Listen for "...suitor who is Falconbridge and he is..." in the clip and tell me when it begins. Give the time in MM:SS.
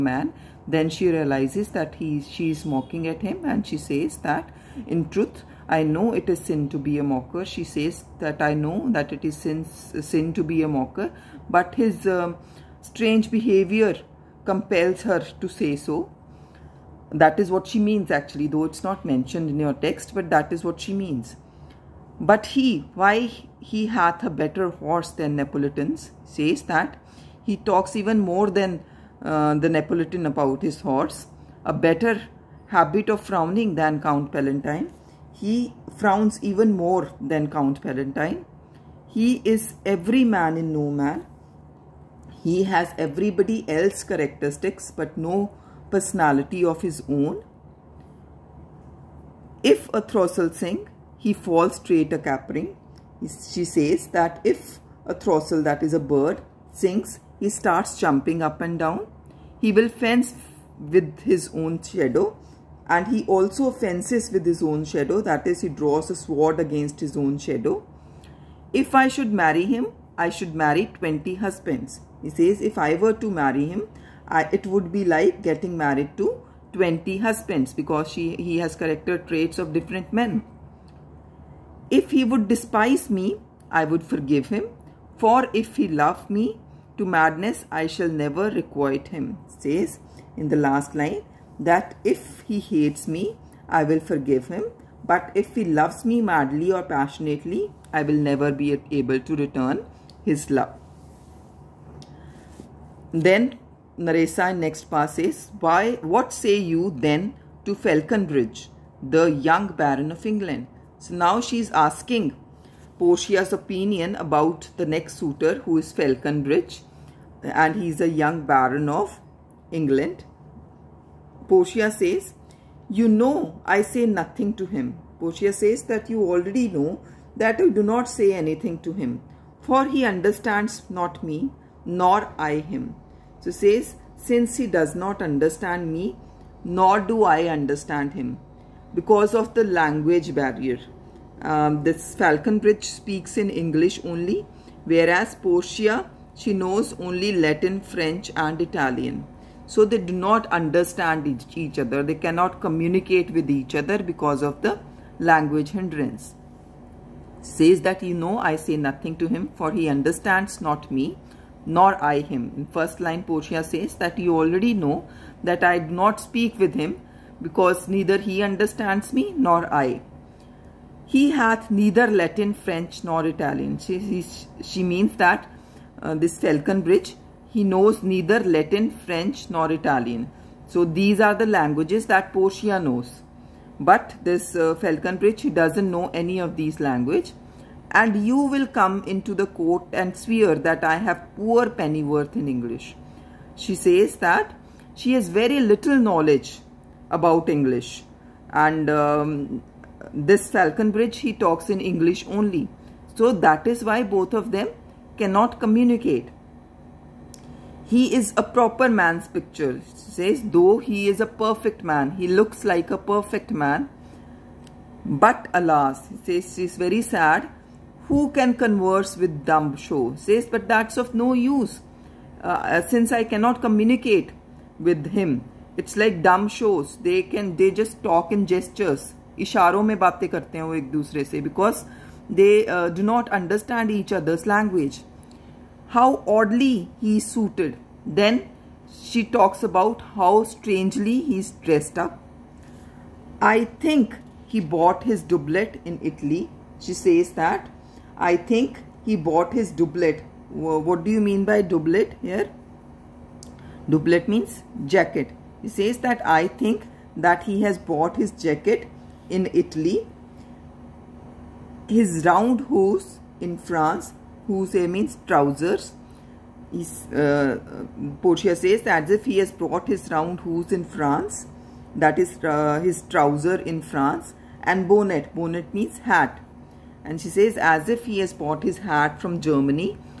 01:55.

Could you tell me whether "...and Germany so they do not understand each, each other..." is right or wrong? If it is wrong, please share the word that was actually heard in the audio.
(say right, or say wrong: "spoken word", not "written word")
wrong: "Italian", not "Germany".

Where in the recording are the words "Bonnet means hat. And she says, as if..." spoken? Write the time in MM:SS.
04:35.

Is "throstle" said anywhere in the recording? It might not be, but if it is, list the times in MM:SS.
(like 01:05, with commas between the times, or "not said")
00:50, 00:55.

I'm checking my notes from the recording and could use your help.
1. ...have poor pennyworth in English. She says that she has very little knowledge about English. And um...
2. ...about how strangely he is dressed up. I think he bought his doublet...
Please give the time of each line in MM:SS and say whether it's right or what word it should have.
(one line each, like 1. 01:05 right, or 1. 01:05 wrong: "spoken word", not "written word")
1. 03:10 right
2. 03:59 right.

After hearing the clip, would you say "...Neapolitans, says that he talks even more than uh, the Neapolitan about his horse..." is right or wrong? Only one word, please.
right.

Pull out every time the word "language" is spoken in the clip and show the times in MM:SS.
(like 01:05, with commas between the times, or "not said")
02:19, 02:35, 03:01, 03:06, 03:54.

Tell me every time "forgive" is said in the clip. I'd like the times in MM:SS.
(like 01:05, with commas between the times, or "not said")
01:24, 01:33.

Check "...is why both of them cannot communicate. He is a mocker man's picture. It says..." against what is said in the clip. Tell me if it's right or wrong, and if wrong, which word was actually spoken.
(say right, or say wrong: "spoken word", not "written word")
wrong: "proper", not "mocker".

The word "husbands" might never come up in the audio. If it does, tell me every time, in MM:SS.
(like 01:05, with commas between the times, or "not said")
01:11, 01:17.